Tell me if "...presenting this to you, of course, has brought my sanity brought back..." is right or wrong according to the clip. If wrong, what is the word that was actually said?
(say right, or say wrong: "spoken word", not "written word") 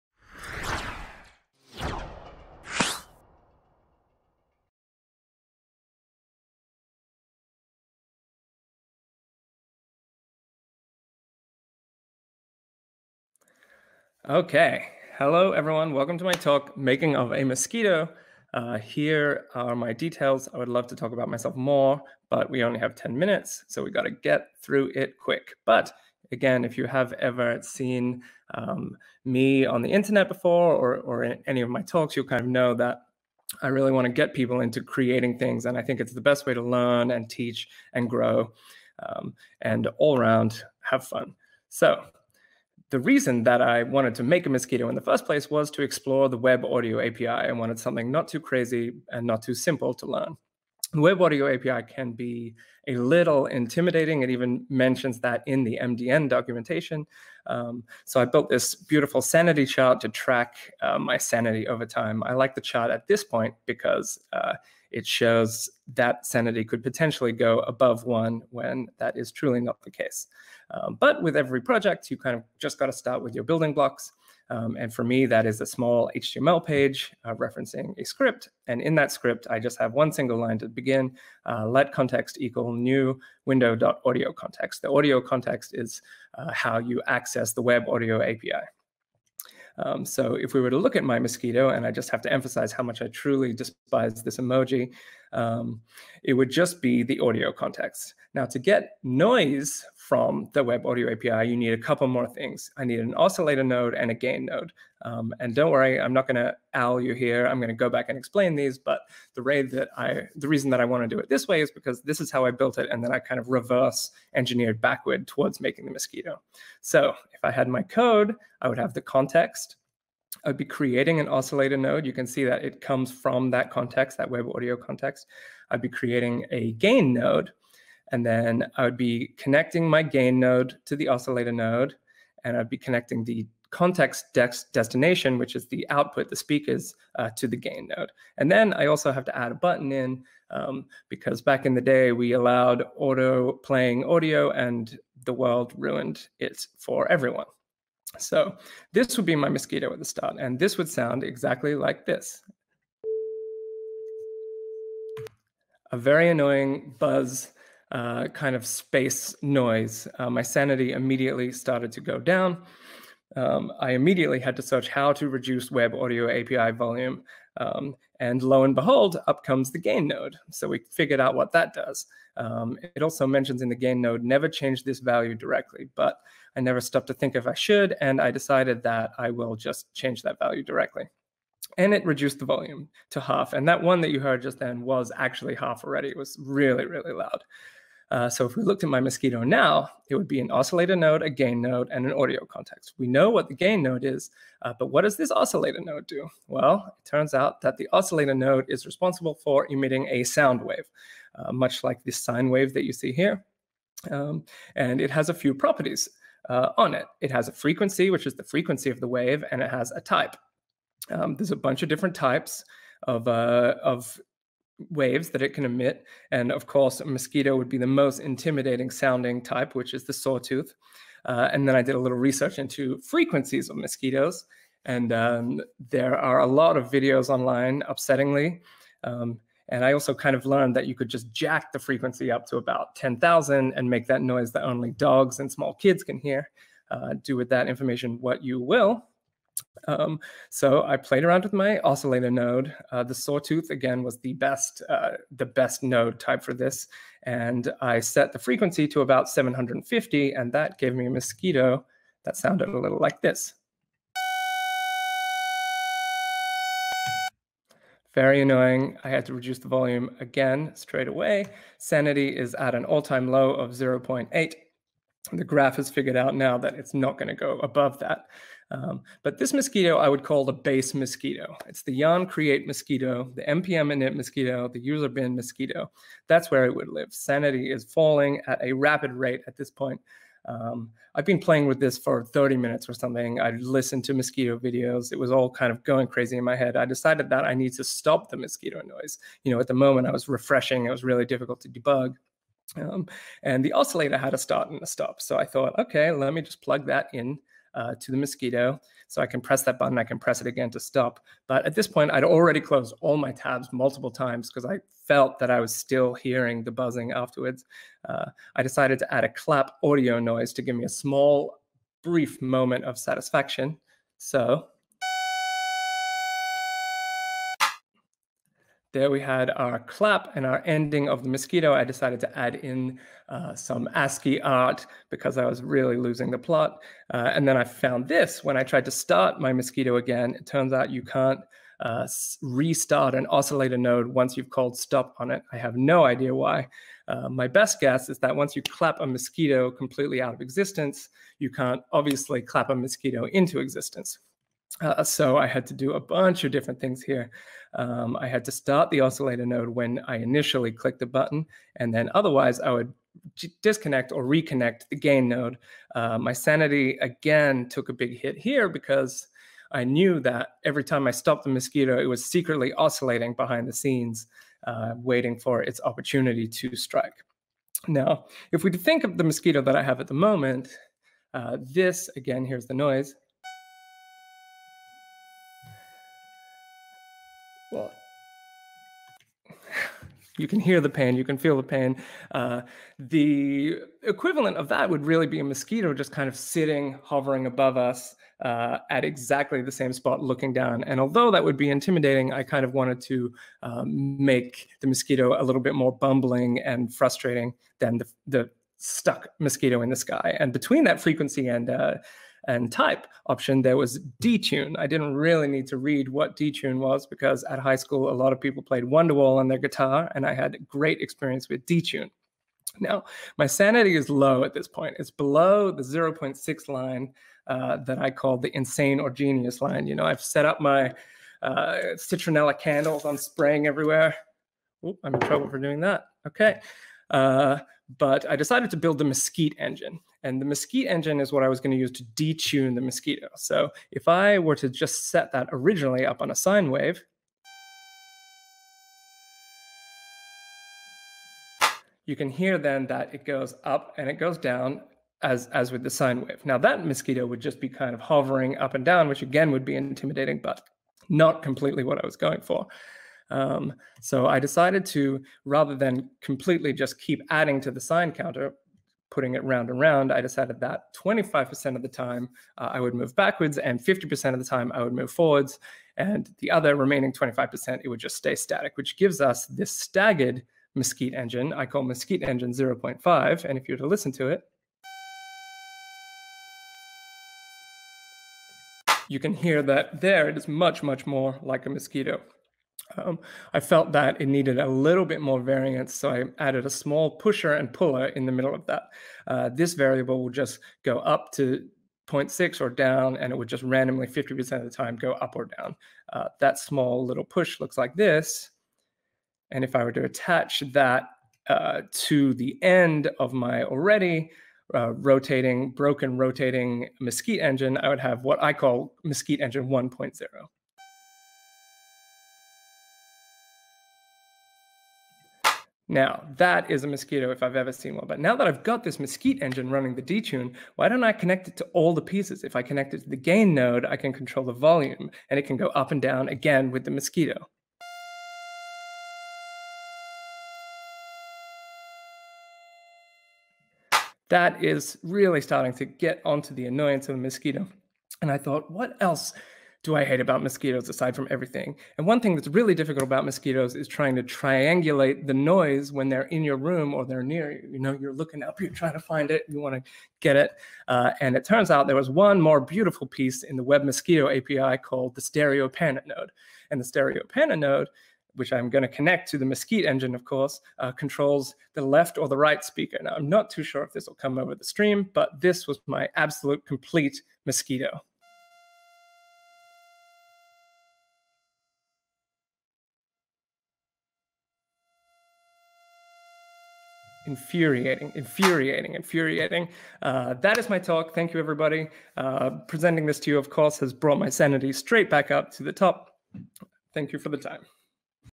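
wrong: "straight", not "brought".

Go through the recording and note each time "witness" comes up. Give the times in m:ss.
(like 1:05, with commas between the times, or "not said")
not said.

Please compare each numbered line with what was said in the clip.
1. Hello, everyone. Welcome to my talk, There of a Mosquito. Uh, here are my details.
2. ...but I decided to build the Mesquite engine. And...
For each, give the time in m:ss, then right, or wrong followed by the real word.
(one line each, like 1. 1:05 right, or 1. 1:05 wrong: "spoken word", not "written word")
1. 0:15 wrong: "Making", not "There"
2. 7:07 right.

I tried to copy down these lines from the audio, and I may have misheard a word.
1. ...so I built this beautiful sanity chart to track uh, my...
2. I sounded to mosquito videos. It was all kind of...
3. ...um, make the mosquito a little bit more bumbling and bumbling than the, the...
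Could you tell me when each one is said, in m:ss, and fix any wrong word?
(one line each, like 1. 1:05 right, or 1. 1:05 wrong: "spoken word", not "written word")
1. 0:58 right
2. 4:43 wrong: "listened", not "sounded"
3. 6:33 wrong: "frustrating", not "bumbling".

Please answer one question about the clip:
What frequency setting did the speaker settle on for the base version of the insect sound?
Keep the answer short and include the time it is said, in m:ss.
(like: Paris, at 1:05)
750, at 4:09.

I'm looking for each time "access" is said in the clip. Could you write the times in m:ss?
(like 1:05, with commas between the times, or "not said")
1:27.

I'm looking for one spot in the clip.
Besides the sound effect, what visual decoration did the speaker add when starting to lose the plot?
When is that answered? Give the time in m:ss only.
5:23.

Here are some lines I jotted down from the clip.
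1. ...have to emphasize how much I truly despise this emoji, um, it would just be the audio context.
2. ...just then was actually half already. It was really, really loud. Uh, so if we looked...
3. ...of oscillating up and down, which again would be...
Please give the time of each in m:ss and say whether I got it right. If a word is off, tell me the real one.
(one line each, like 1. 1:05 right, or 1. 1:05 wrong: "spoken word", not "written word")
1. 1:32 right
2. 3:04 right
3. 7:27 wrong: "hovering", not "oscillating".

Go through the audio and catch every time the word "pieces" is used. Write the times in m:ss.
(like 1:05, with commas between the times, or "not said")
8:42, 9:13.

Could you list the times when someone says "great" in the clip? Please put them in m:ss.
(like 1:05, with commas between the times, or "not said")
6:50.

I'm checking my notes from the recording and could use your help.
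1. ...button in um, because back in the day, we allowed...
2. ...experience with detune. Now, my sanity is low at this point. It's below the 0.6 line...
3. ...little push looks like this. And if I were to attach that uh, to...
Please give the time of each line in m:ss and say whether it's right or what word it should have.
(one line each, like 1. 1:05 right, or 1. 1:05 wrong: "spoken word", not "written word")
1. 2:19 right
2. 6:51 right
3. 8:17 right.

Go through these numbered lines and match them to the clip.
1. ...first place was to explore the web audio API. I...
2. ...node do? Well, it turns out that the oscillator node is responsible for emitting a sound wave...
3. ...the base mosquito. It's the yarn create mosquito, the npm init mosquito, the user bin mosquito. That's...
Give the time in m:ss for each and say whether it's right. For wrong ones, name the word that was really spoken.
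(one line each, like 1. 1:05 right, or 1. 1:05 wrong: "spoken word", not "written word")
1. 0:45 right
2. 3:15 right
3. 4:30 right.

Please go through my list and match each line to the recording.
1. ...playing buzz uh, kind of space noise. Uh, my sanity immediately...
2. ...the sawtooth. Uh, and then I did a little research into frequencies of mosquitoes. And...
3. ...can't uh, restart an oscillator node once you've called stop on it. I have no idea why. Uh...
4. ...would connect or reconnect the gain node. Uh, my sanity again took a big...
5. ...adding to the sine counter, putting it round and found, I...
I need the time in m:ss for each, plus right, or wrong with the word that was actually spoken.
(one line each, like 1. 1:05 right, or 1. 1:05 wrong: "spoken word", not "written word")
1. 2:36 wrong: "annoying", not "playing"
2. 3:40 right
3. 5:31 right
4. 5:52 wrong: "disconnect", not "connect"
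5. 7:37 wrong: "round", not "found".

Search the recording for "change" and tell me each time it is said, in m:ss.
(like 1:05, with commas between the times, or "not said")
2:54, 2:59.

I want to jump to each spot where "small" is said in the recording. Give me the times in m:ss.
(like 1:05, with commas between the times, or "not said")
1:15, 3:55, 5:10, 8:06, 8:16.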